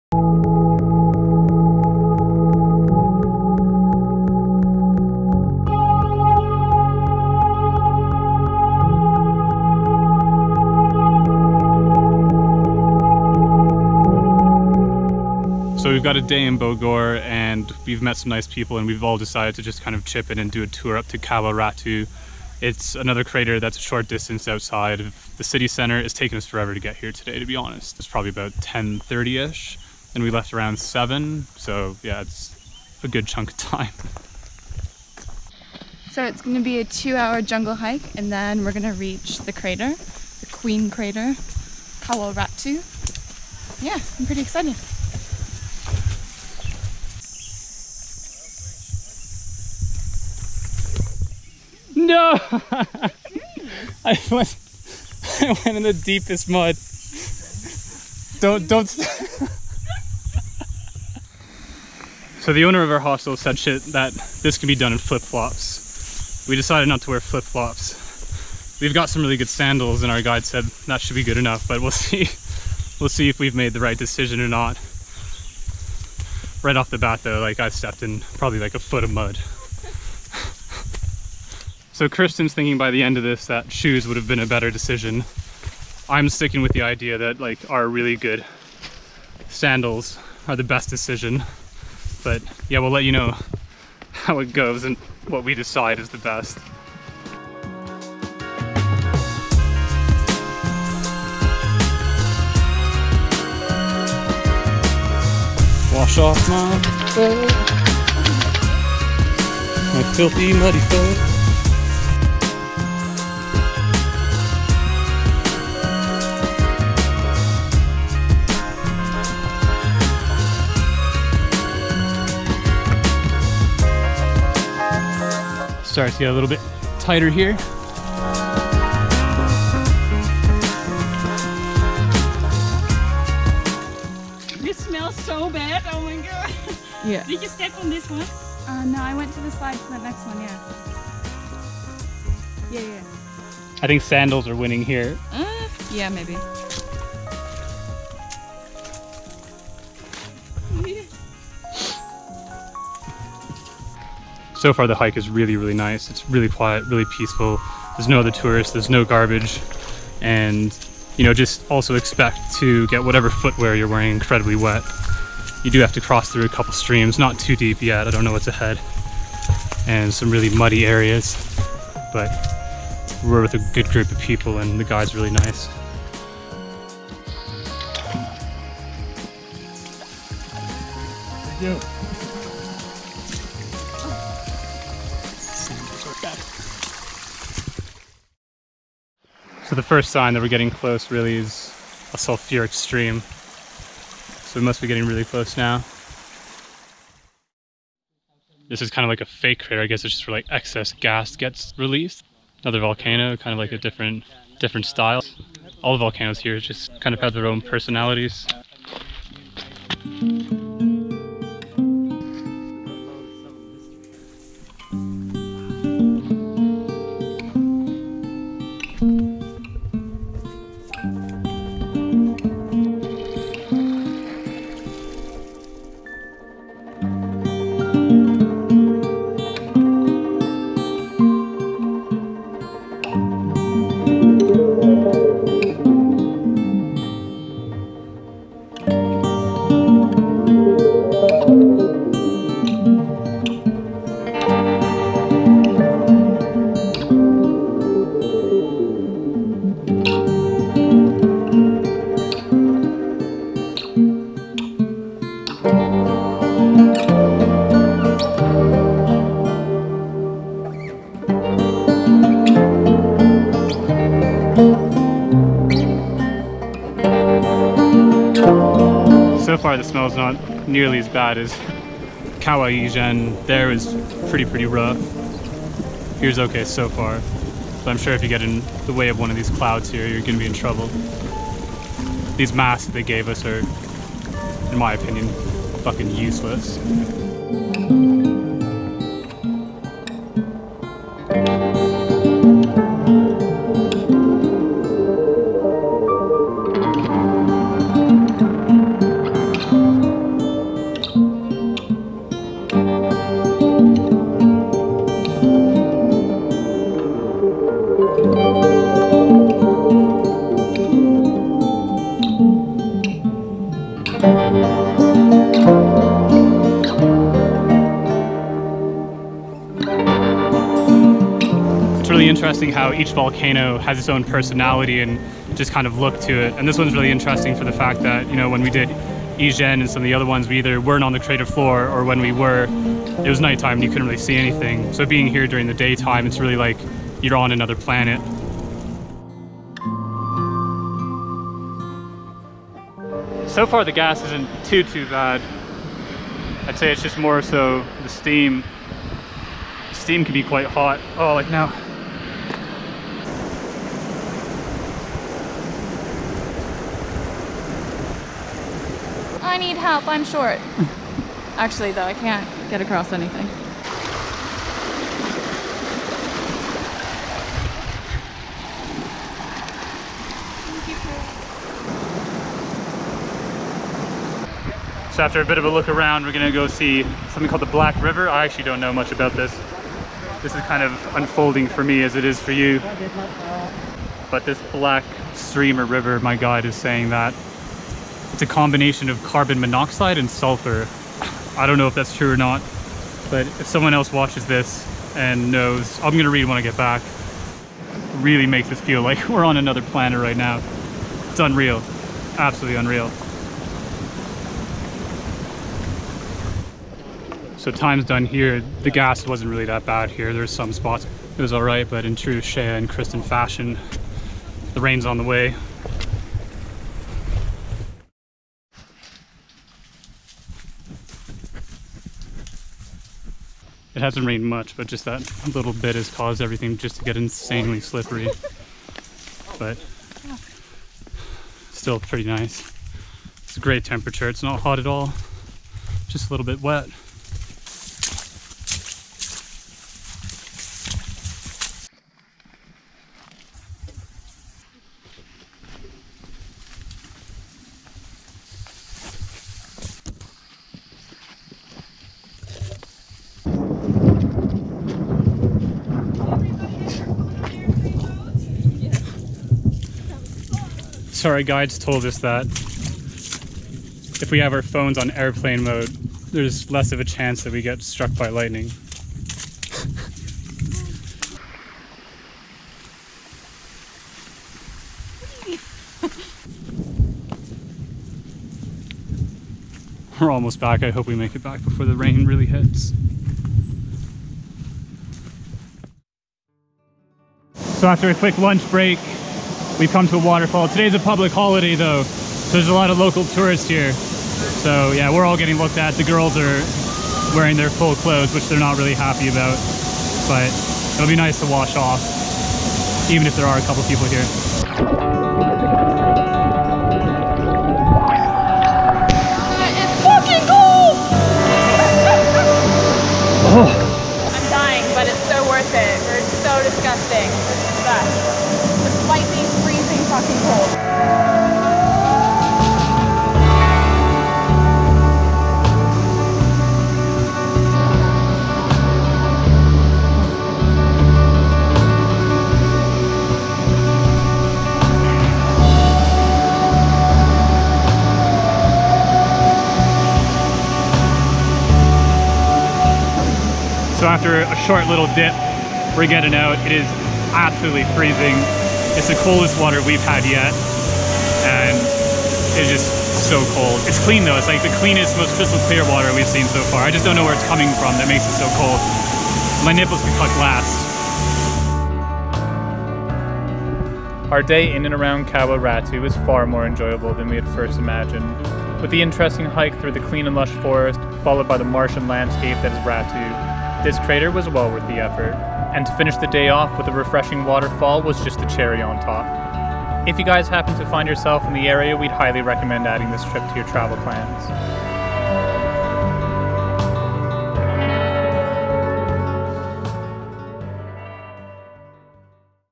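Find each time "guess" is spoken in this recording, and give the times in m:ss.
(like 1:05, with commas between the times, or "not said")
3:19.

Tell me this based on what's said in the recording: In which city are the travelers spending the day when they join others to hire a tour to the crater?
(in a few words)
Bogor.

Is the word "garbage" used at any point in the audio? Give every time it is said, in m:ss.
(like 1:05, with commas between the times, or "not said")
2:39.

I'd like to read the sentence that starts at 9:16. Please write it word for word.
I just don't know where it's coming from that makes it so cold.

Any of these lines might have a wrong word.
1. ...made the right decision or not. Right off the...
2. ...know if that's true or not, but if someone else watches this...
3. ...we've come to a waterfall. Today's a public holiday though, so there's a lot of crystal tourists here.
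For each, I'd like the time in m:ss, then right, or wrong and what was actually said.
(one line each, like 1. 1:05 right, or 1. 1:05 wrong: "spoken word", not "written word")
1. 1:13 right
2. 6:31 right
3. 8:09 wrong: "local", not "crystal".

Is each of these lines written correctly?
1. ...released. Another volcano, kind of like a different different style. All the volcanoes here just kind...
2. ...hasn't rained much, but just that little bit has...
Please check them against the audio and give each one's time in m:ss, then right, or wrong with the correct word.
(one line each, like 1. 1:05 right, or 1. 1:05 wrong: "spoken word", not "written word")
1. 3:21 right
2. 7:04 right.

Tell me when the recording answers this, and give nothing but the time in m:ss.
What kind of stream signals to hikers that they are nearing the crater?
3:12.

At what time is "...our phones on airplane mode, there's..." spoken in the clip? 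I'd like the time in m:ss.
7:44.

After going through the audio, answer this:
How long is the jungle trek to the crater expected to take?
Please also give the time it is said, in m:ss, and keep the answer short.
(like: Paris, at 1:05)
2 hours, at 0:36.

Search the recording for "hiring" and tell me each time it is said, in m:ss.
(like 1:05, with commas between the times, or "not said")
not said.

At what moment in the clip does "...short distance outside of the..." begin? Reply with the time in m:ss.
0:23.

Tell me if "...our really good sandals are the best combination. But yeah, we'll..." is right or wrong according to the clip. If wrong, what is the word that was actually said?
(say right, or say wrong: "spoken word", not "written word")
wrong: "decision", not "combination".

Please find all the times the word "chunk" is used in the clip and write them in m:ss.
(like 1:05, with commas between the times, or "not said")
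0:33.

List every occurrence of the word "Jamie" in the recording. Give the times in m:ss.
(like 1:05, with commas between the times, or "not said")
not said.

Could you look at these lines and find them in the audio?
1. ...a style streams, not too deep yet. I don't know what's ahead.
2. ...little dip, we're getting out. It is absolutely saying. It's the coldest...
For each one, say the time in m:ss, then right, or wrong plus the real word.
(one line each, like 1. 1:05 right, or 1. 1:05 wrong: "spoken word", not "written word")
1. 2:46 wrong: "couple", not "style"
2. 9:04 wrong: "freezing", not "saying".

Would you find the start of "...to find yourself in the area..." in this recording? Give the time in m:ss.
9:40.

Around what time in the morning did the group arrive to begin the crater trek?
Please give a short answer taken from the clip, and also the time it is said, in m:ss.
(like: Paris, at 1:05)
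10:30, at 0:28.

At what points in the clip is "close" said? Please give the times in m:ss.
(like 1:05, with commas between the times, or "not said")
3:10, 3:15.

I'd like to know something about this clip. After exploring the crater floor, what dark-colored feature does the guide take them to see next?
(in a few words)
The Black River.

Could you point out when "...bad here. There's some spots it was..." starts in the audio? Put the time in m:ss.
6:49.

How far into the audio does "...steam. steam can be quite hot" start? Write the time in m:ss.
5:48.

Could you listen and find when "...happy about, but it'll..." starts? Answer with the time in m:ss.
8:18.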